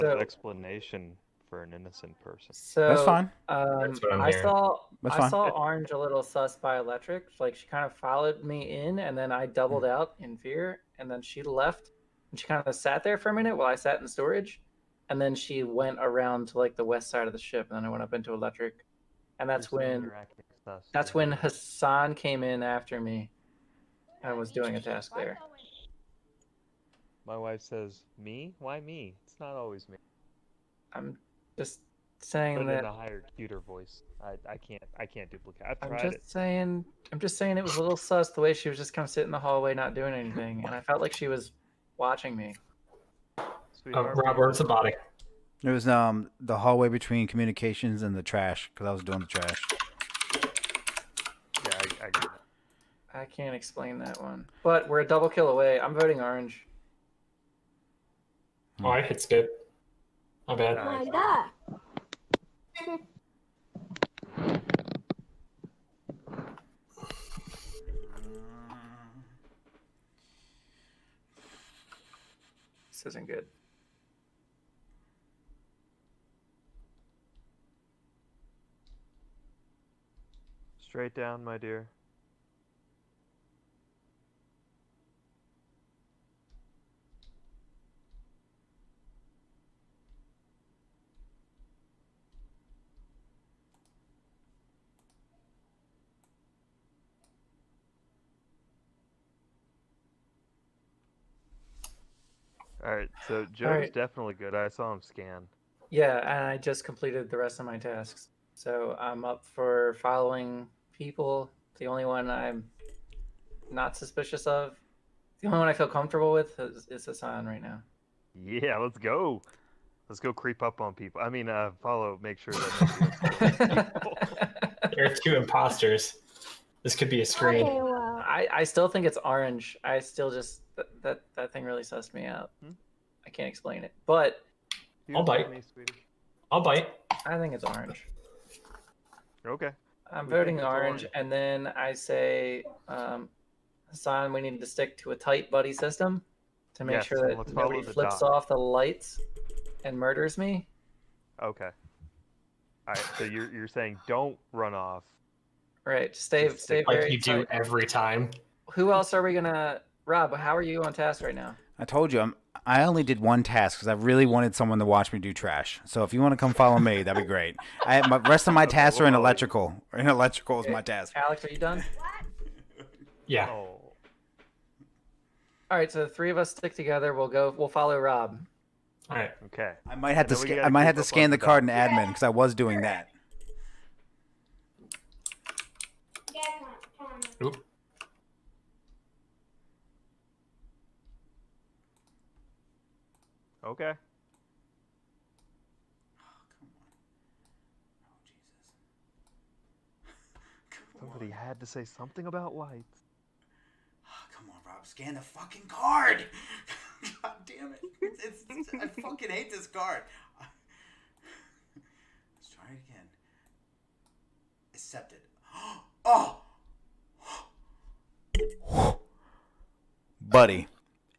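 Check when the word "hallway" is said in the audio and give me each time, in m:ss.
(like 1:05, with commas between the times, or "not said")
0:39, 0:46.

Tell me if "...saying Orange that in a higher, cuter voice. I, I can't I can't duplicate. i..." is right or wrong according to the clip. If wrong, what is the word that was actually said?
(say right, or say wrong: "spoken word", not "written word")
wrong: "Put", not "Orange".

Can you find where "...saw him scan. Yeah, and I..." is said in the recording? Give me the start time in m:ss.
1:44.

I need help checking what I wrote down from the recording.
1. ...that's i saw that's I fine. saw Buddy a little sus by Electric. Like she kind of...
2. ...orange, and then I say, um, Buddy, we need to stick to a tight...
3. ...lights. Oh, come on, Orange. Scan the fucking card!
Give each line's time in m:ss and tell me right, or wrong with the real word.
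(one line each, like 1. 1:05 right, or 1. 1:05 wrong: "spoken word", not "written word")
1. 0:03 wrong: "Orange", not "Buddy"
2. 2:21 wrong: "Hassan", not "Buddy"
3. 3:22 wrong: "Rob", not "Orange".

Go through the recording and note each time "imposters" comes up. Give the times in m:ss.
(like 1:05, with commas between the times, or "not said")
2:05.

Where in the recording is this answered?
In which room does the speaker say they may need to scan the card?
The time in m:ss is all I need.
3:01.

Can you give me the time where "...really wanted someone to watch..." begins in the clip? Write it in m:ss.
2:43.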